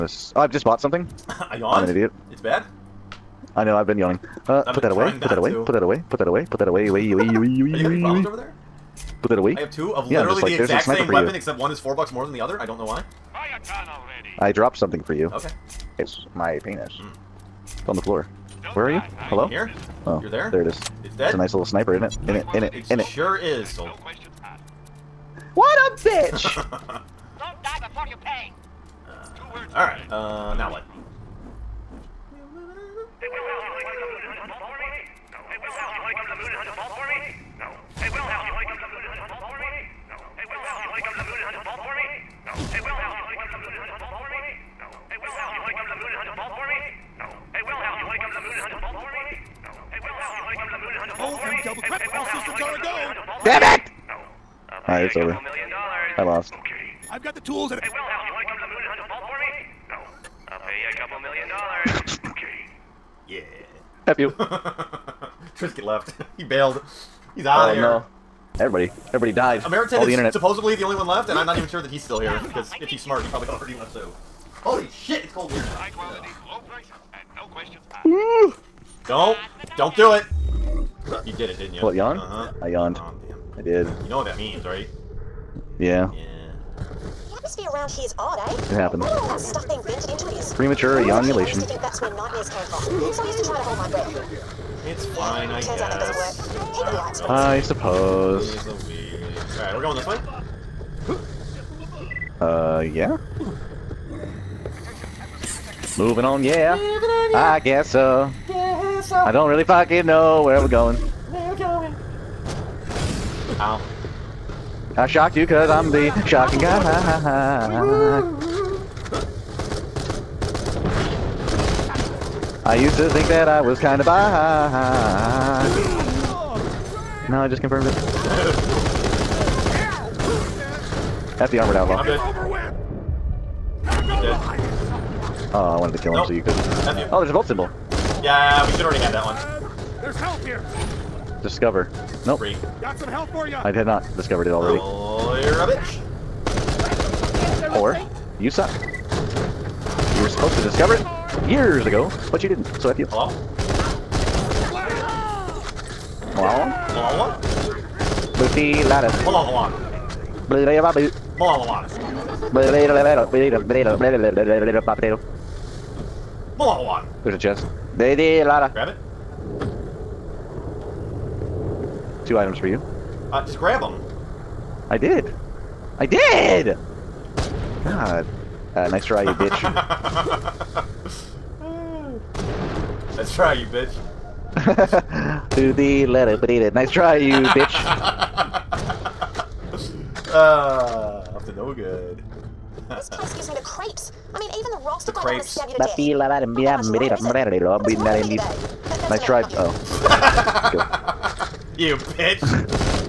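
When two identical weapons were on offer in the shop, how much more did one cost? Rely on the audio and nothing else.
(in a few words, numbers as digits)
$4.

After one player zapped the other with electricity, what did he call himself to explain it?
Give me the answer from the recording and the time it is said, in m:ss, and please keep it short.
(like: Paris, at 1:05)
the shocking guy, at 1:55.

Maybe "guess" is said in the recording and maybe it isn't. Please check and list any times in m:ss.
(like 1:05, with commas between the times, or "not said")
1:35, 1:47.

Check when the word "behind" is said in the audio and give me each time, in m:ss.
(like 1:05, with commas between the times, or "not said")
2:04.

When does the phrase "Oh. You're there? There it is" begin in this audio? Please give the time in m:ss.
0:20.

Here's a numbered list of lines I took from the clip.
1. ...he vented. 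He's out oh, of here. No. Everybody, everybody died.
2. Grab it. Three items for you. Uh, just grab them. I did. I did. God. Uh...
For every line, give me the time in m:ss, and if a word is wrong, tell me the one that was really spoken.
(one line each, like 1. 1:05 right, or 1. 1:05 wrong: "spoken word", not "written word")
1. 1:06 wrong: "bailed", not "vented"
2. 2:48 wrong: "Two", not "Three".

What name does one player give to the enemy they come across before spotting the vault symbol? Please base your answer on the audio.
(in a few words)
the armored outlaw.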